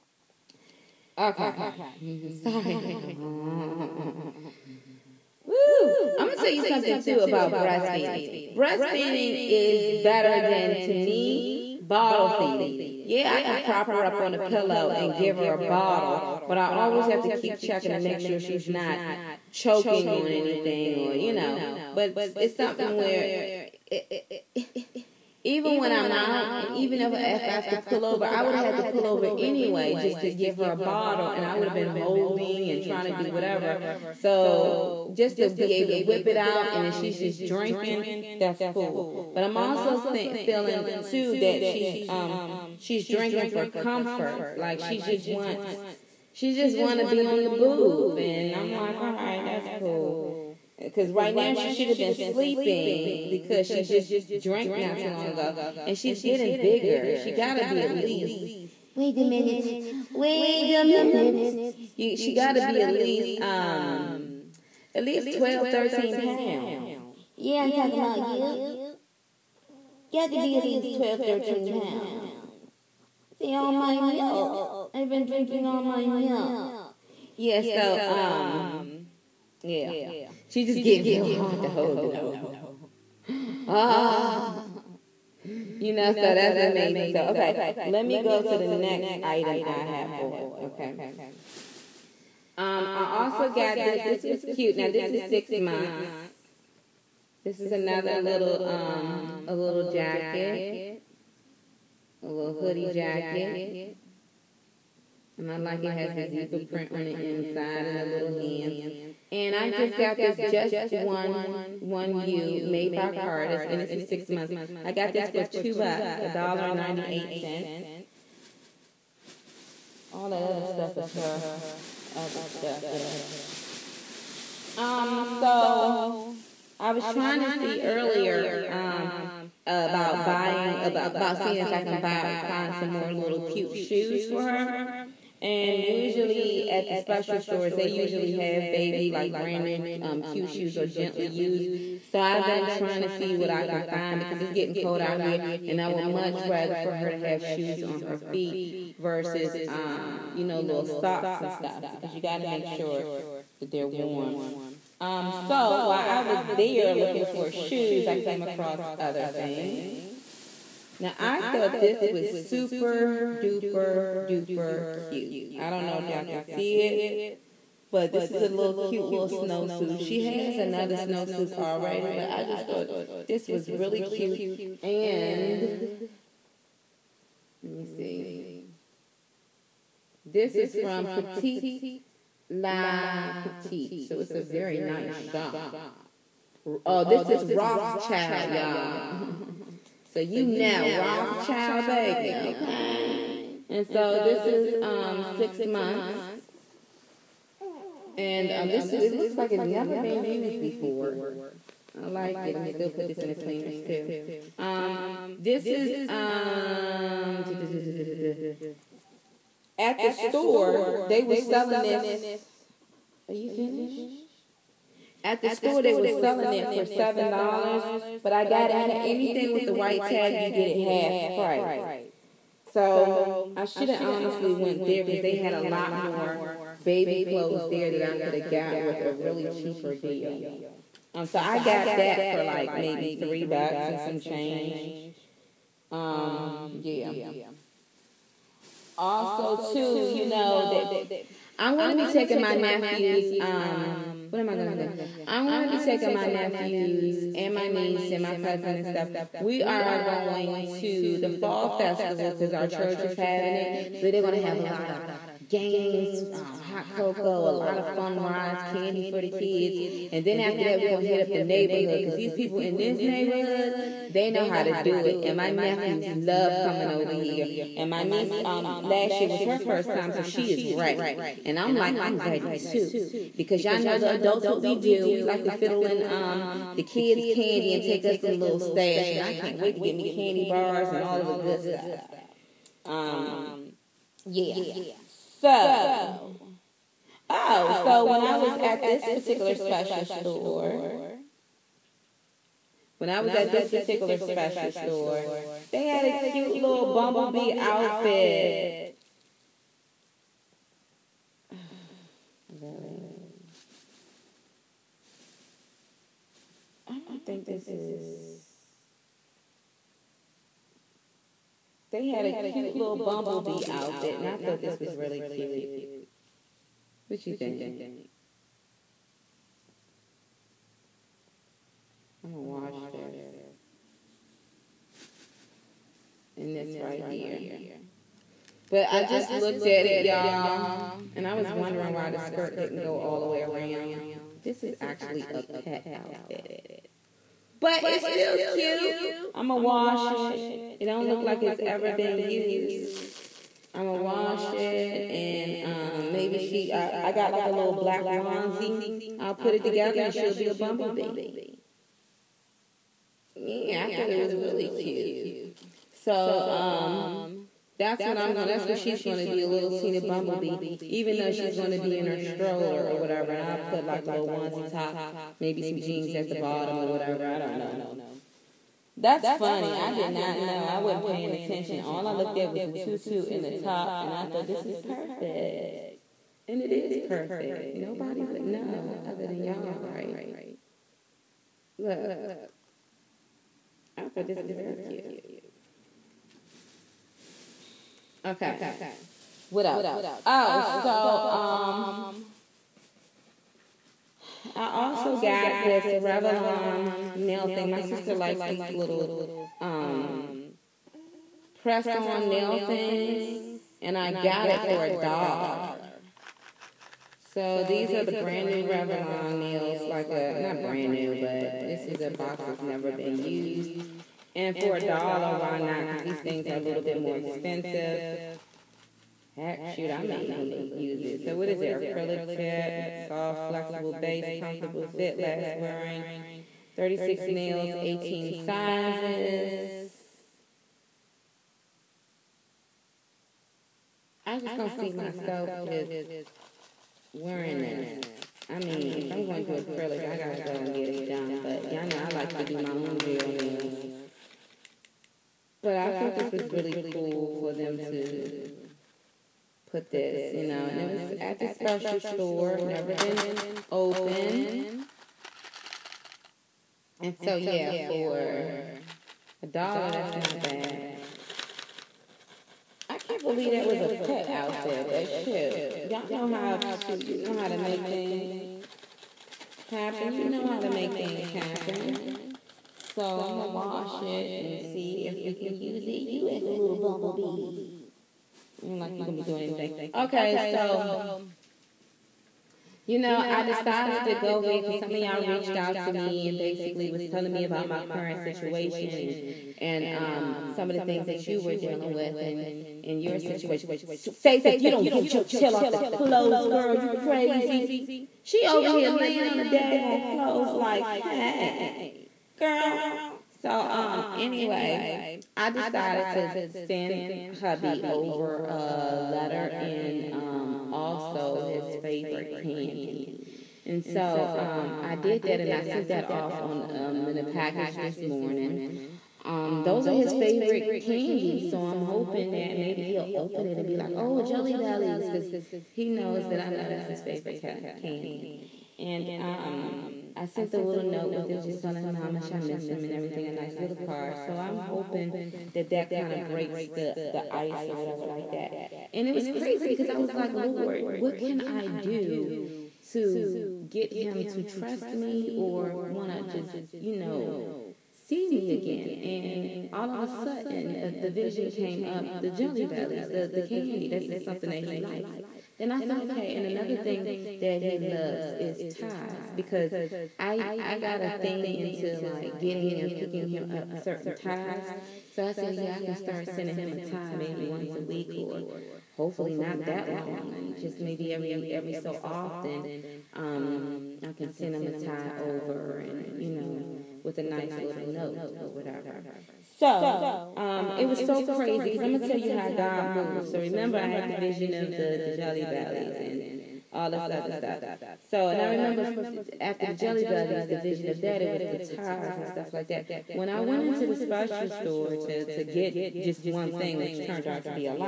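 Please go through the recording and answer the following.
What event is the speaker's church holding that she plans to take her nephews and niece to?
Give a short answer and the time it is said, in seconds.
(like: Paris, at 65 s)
fall festival, at 251 s.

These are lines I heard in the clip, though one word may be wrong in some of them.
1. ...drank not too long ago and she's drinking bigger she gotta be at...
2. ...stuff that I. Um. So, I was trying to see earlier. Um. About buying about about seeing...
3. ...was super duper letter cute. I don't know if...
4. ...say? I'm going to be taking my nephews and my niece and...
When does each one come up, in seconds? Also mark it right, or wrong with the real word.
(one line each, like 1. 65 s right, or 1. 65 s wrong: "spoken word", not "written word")
1. 54 s wrong: "getting", not "drinking"
2. 122 s right
3. 162 s wrong: "duper", not "letter"
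4. 244 s right.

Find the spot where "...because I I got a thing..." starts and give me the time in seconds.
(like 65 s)
559 s.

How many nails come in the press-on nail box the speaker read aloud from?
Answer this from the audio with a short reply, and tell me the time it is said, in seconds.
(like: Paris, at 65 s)
36, at 426 s.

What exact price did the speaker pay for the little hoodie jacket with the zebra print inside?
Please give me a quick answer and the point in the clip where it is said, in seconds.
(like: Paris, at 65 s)
$1.98, at 116 s.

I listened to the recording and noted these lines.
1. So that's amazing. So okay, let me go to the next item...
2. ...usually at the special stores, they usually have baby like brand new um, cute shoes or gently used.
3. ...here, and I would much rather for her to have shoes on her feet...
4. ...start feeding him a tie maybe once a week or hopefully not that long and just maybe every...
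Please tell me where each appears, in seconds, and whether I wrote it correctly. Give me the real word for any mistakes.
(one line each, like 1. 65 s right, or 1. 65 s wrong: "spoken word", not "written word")
1. 86 s right
2. 135 s right
3. 145 s right
4. 565 s wrong: "sending", not "feeding".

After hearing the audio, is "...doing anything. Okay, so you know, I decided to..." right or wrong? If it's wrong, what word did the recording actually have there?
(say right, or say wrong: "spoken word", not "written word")
right.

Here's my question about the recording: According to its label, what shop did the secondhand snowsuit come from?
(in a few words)
Petite La Petite.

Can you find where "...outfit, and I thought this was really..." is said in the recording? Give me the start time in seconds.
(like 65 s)
313 s.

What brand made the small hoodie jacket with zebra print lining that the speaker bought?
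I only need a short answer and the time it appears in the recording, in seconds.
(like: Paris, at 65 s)
Carter's, at 113 s.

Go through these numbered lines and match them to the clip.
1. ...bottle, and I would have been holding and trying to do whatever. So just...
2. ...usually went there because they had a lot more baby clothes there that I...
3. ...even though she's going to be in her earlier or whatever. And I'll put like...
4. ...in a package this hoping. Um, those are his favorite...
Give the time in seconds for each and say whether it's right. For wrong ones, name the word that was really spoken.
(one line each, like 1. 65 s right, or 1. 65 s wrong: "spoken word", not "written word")
1. 30 s right
2. 224 s wrong: "honestly", not "usually"
3. 360 s wrong: "stroller", not "earlier"
4. 517 s wrong: "morning", not "hoping".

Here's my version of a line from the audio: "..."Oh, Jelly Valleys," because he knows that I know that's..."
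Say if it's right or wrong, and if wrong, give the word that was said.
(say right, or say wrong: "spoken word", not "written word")
wrong: "Bellies", not "Valleys".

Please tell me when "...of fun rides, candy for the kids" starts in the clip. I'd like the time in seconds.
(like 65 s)
257 s.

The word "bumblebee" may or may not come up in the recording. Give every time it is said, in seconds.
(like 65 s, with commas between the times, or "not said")
296 s, 312 s, 350 s, 360 s, 476 s.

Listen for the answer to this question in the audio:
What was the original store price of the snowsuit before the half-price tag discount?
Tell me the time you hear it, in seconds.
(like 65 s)
216 s.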